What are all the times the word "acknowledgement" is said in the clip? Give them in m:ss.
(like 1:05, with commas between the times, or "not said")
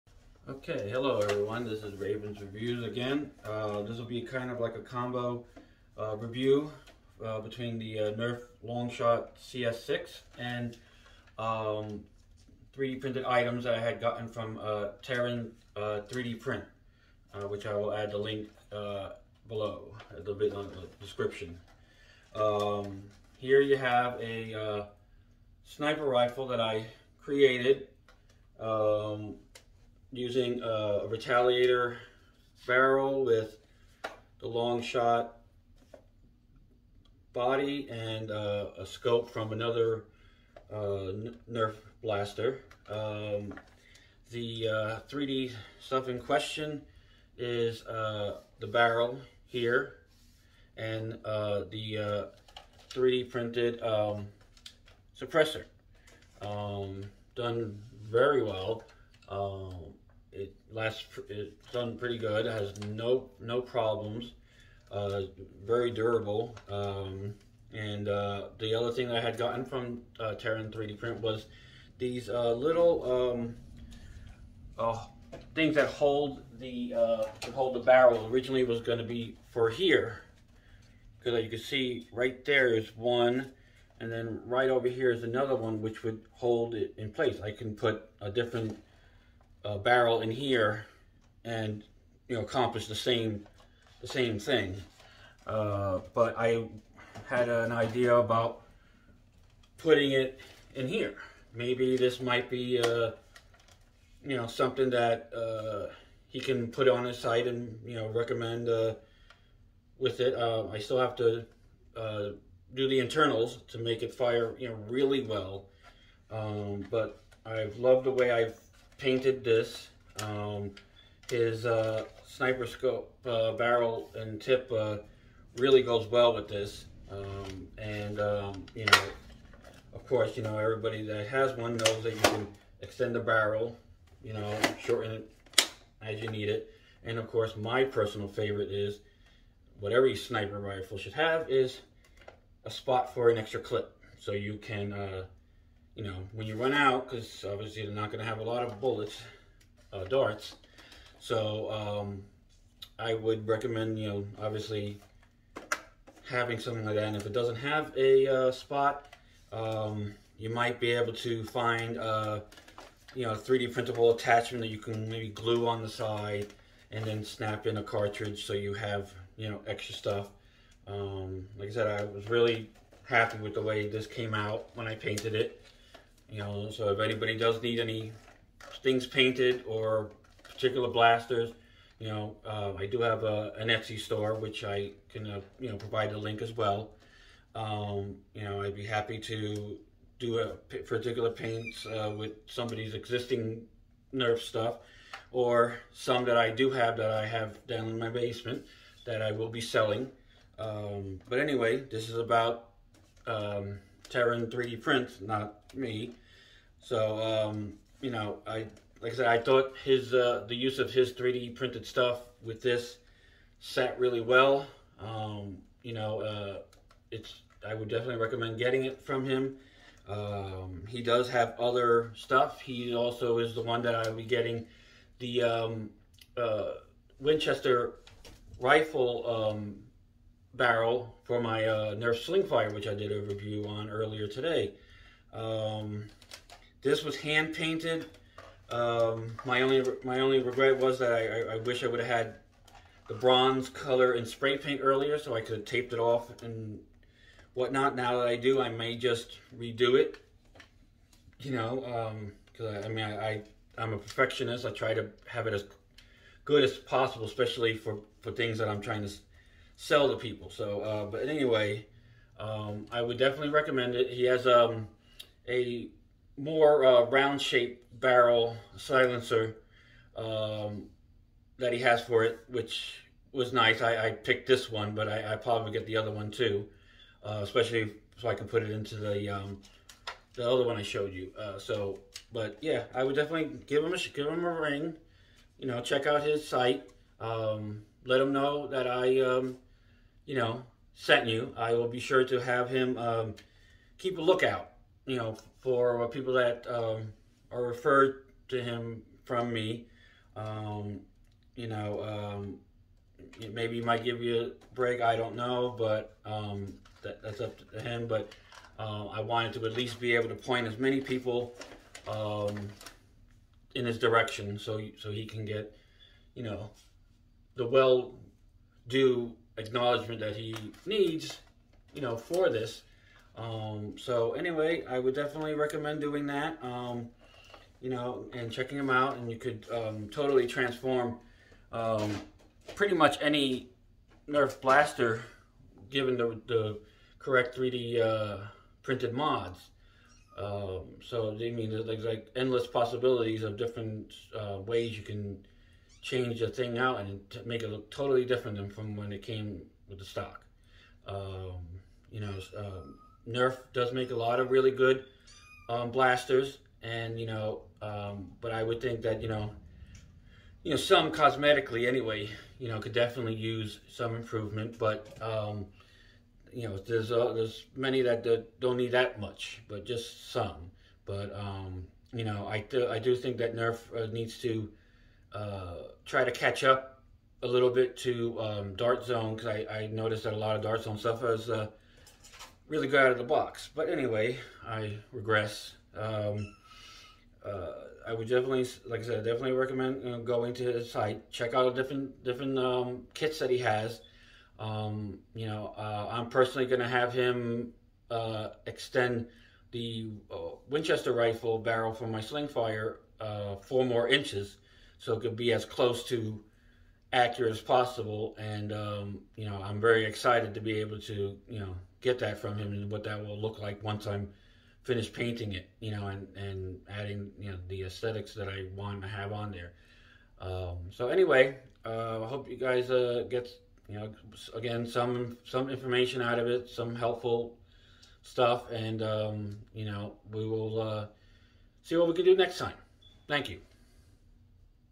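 5:19.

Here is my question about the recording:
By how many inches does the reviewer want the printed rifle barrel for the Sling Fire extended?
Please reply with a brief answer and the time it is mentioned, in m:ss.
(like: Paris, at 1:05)
4, at 6:43.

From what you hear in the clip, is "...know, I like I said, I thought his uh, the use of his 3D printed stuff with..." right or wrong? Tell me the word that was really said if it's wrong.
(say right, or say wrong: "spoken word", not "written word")
right.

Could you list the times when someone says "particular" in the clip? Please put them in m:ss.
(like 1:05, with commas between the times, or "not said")
3:00, 3:10.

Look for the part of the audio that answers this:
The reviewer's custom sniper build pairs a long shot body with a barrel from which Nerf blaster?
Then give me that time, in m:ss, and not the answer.
0:31.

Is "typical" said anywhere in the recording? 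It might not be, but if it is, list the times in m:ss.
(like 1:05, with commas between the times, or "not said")
not said.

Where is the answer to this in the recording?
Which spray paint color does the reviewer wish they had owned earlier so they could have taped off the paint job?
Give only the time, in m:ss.
4:03.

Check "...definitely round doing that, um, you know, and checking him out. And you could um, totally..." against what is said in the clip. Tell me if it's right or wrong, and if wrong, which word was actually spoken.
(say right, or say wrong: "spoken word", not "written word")
wrong: "recommend", not "round".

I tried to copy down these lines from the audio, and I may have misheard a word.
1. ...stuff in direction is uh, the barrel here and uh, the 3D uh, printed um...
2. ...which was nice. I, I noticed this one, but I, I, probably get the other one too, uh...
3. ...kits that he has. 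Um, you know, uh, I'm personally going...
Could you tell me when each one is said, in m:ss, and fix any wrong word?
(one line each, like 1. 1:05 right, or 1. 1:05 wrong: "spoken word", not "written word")
1. 0:45 wrong: "question", not "direction"
2. 4:32 wrong: "picked", not "noticed"
3. 6:33 right.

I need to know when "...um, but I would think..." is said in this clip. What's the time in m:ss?
5:57.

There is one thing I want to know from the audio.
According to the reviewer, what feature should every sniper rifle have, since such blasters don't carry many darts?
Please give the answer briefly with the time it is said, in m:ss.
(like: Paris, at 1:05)
A spot for an extra clip, at 2:22.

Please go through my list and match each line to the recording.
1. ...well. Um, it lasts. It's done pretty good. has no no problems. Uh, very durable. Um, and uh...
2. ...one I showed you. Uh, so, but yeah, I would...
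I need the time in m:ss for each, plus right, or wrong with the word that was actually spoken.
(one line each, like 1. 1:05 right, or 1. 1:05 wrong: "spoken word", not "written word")
1. 0:58 right
2. 4:40 right.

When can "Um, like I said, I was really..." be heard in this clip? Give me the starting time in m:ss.
2:50.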